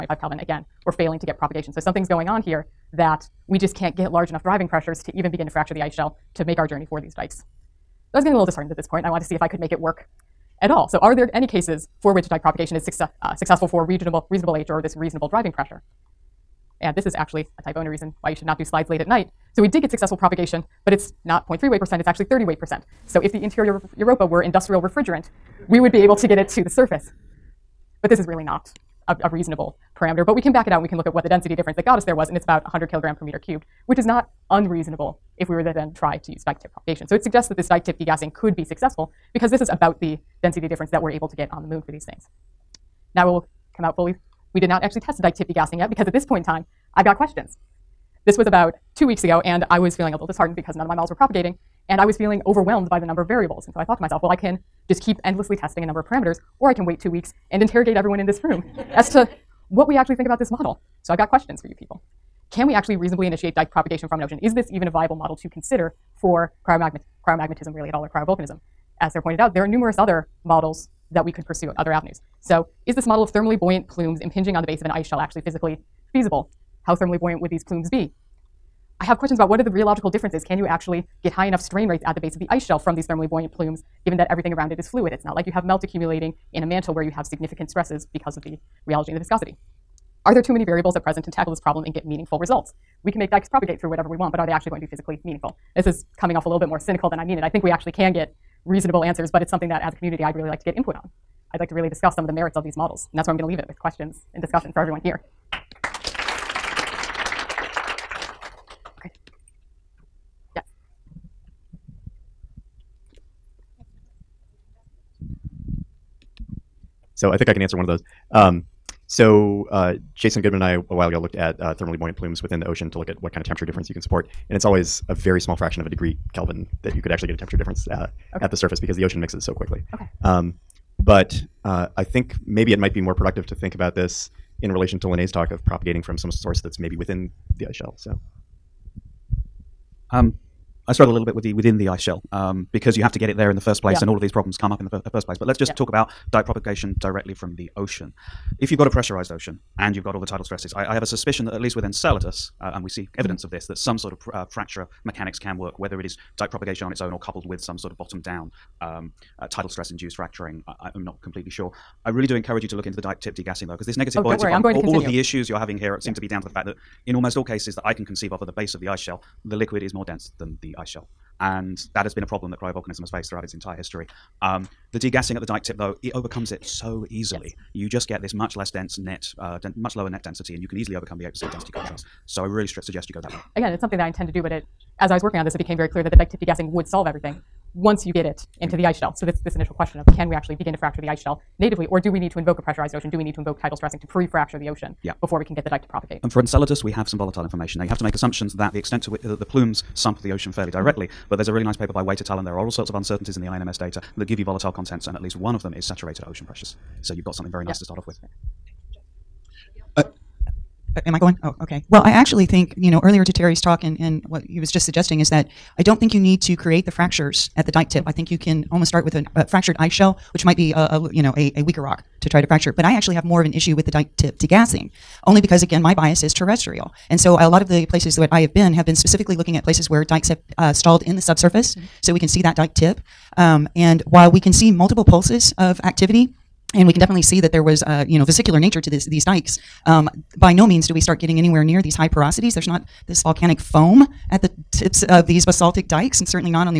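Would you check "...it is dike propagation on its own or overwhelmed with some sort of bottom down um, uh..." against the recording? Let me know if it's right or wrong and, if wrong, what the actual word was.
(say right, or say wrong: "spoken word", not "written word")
wrong: "coupled", not "overwhelmed".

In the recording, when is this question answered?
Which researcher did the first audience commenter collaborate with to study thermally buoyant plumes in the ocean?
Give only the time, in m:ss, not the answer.
2:00.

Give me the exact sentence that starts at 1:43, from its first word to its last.
And that's where I'm going to leave it with questions and discussion for everyone here.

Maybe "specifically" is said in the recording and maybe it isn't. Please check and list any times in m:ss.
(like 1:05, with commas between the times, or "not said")
3:48.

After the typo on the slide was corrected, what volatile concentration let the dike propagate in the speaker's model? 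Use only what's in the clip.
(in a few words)
30 weight percent.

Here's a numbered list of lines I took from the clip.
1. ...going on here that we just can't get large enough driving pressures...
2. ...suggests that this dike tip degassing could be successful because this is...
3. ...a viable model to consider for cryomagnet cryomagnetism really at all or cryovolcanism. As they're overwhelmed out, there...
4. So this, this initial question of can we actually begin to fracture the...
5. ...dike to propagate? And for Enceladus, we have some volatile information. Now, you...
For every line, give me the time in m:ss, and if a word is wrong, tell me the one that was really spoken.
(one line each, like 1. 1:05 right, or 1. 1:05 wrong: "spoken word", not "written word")
1. 0:02 right
2. 0:37 right
3. 1:04 wrong: "pointed", not "overwhelmed"
4. 3:09 right
5. 3:15 right.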